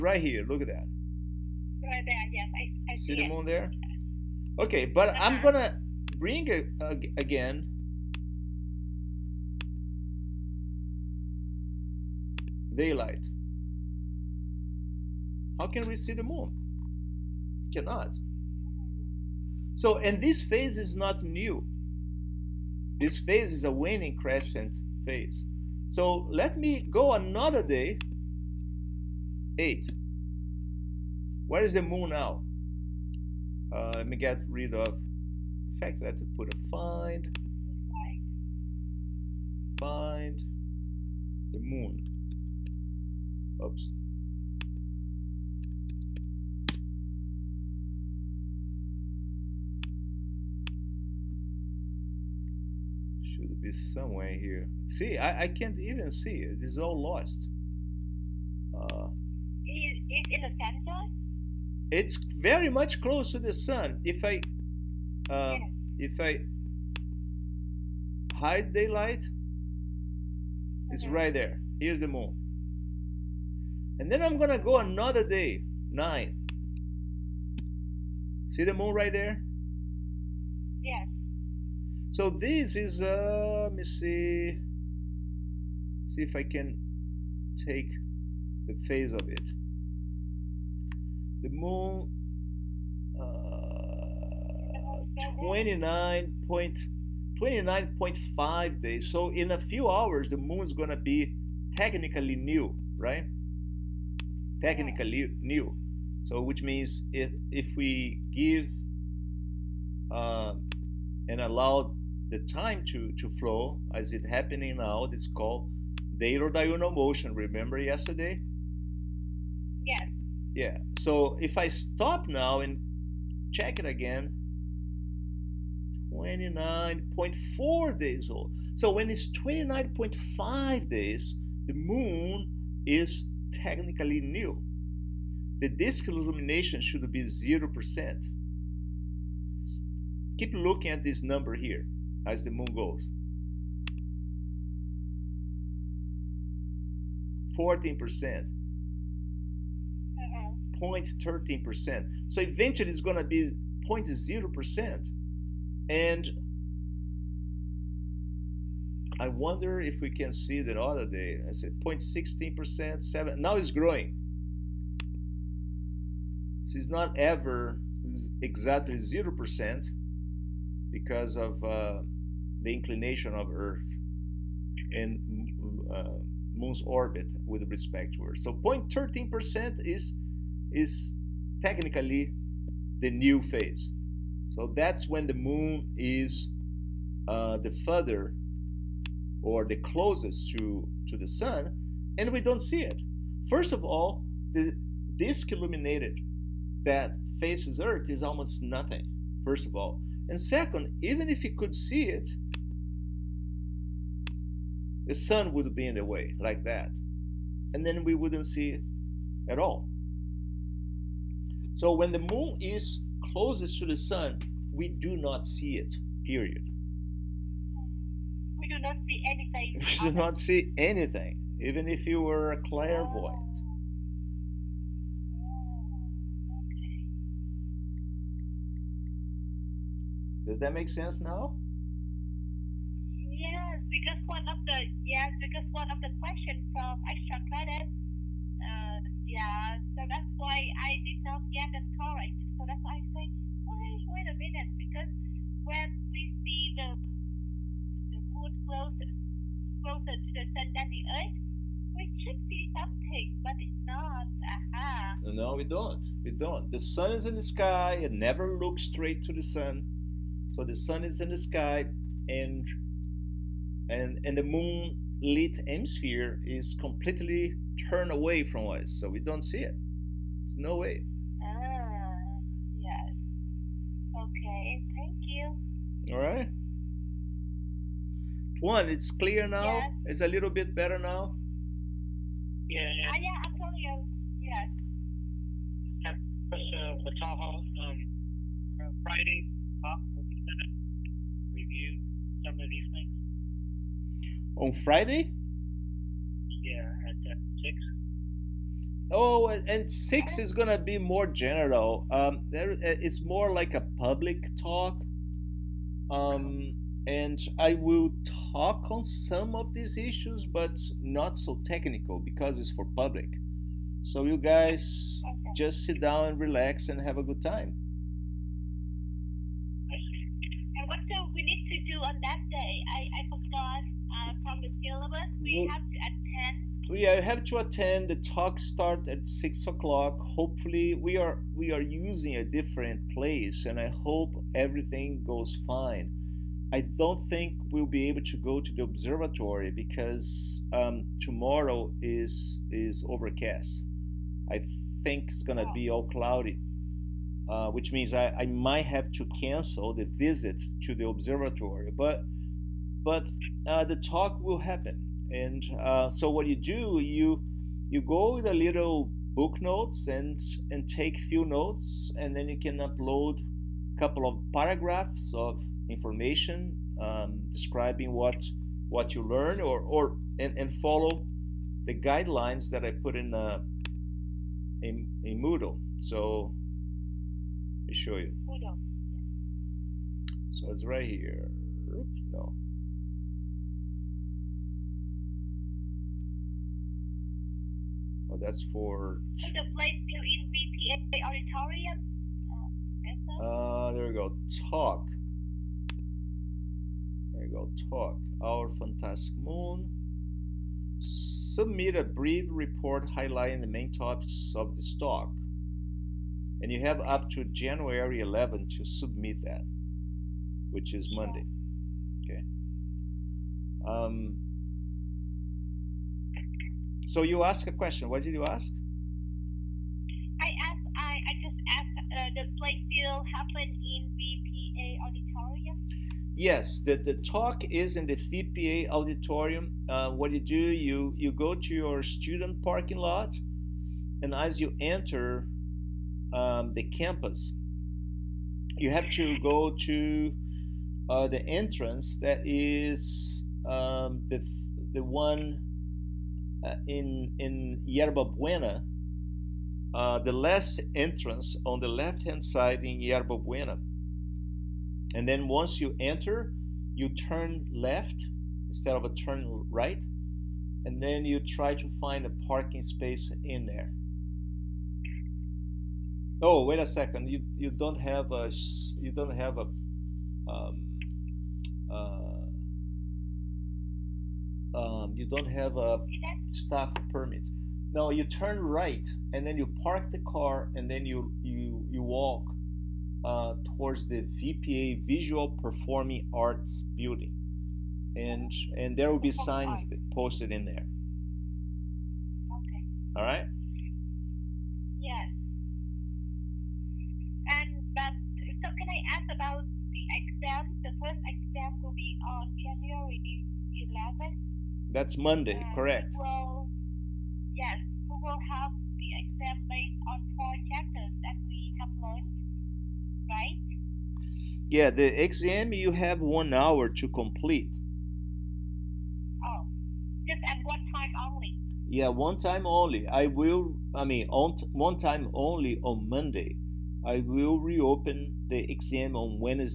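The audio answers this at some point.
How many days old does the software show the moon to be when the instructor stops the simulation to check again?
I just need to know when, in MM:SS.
02:06.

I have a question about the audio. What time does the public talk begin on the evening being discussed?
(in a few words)
6 o'clock.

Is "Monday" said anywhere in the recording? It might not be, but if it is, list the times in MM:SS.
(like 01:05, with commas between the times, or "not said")
06:51, 08:25, 08:46.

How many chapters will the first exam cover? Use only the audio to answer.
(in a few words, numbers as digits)
4.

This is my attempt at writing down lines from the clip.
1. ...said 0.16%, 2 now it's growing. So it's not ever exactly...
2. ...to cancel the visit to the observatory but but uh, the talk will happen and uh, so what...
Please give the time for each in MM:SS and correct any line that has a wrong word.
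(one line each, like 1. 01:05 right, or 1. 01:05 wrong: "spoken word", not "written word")
1. 02:41 wrong: "7", not "2"
2. 05:49 right.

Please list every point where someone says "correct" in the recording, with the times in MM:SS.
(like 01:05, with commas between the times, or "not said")
04:01, 08:25.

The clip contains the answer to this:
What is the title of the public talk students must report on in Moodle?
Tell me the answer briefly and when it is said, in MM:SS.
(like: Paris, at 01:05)
Our fantastic moon, at 06:38.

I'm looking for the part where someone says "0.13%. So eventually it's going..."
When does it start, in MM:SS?
02:30.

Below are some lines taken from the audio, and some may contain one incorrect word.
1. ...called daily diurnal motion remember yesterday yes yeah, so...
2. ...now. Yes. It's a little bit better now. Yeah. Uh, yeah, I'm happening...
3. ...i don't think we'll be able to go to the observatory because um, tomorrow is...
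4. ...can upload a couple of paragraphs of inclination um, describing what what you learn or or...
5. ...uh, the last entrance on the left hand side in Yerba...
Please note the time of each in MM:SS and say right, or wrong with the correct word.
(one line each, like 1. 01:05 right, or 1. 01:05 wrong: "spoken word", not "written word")
1. 01:55 right
2. 04:39 wrong: "telling", not "happening"
3. 05:36 right
4. 06:02 wrong: "information", not "inclination"
5. 07:29 right.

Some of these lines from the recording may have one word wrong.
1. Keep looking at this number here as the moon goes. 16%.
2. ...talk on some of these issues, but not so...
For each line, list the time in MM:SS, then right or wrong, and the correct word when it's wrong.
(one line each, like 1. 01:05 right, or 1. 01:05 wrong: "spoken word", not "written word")
1. 02:20 wrong: "14", not "16"
2. 05:08 right.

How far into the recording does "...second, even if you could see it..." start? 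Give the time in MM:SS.
03:20.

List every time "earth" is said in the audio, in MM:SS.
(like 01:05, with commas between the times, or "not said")
02:53, 02:58, 03:17, 04:11.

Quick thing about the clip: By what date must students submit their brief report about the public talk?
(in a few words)
January 11.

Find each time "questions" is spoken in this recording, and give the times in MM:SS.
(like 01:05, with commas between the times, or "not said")
03:56, 06:57.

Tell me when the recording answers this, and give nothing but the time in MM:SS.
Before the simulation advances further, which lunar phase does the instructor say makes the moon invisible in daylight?
00:23.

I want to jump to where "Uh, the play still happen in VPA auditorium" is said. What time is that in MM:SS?
07:02.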